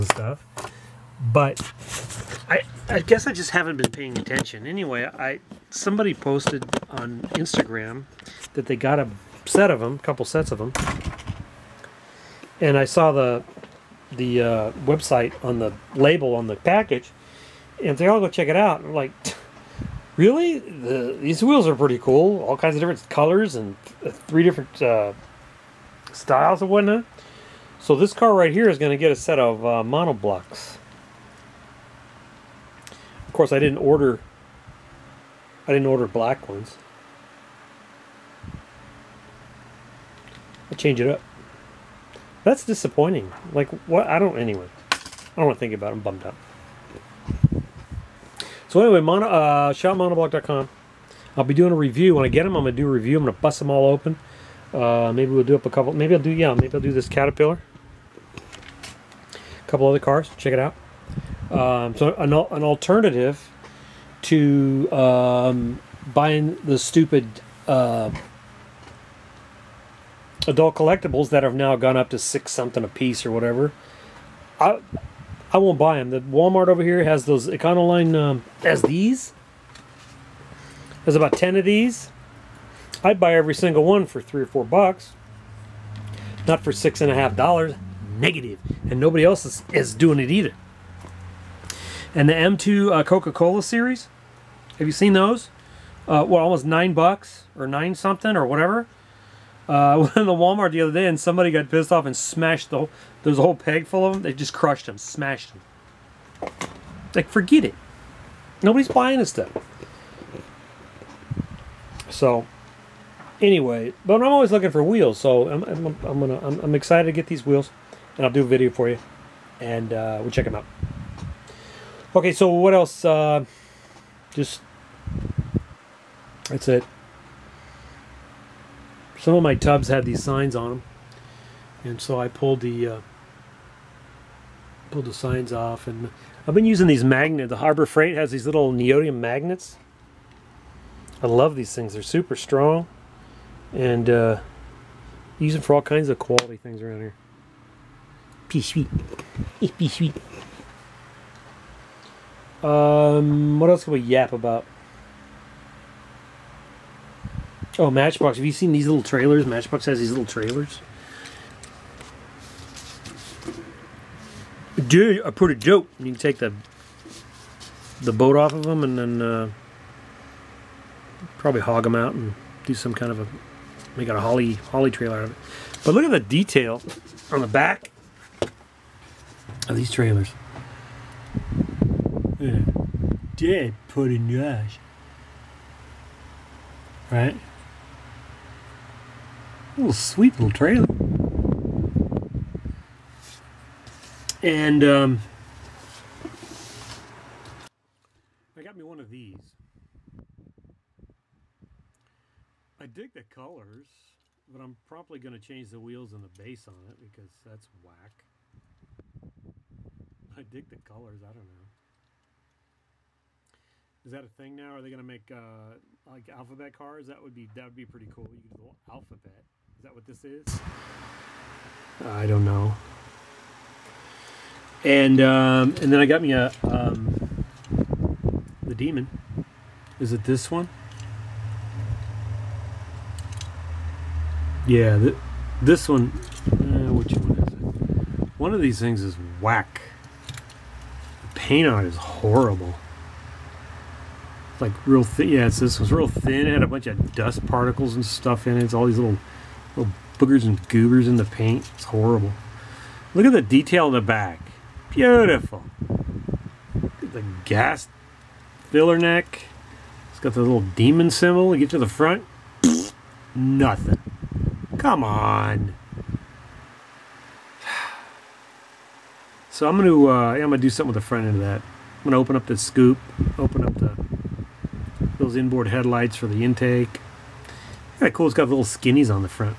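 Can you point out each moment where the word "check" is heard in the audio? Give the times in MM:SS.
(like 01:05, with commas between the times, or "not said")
00:18, 01:00, 02:00.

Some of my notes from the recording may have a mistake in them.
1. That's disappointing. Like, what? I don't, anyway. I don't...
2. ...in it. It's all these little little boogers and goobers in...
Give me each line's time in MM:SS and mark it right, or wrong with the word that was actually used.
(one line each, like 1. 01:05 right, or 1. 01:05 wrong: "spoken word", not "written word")
1. 00:42 right
2. 04:08 right.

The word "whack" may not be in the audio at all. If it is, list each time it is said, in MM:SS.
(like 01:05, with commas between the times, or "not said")
03:27, 03:59.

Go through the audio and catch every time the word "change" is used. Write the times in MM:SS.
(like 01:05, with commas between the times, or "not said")
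00:40, 03:25.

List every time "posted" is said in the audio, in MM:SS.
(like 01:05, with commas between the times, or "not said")
00:06.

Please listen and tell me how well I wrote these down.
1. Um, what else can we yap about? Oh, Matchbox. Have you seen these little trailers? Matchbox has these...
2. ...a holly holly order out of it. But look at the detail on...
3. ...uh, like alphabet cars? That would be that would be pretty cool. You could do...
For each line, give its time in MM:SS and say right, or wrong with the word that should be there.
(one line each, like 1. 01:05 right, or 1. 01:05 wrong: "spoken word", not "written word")
1. 02:32 right
2. 02:54 wrong: "trailer", not "order"
3. 03:35 right.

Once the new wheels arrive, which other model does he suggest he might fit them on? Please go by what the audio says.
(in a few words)
Caterpillar.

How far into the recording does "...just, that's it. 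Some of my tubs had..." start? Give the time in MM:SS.
02:04.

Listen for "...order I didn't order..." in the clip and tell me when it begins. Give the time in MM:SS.
00:33.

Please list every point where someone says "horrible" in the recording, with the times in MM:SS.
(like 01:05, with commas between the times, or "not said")
04:01, 04:11.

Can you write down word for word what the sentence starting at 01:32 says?
And the M2 uh, Coca-Cola series, have you seen those?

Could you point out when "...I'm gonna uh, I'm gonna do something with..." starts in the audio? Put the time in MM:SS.
04:29.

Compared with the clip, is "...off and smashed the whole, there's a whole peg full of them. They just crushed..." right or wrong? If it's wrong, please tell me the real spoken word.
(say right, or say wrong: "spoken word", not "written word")
right.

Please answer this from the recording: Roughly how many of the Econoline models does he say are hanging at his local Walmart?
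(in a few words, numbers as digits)
about 10.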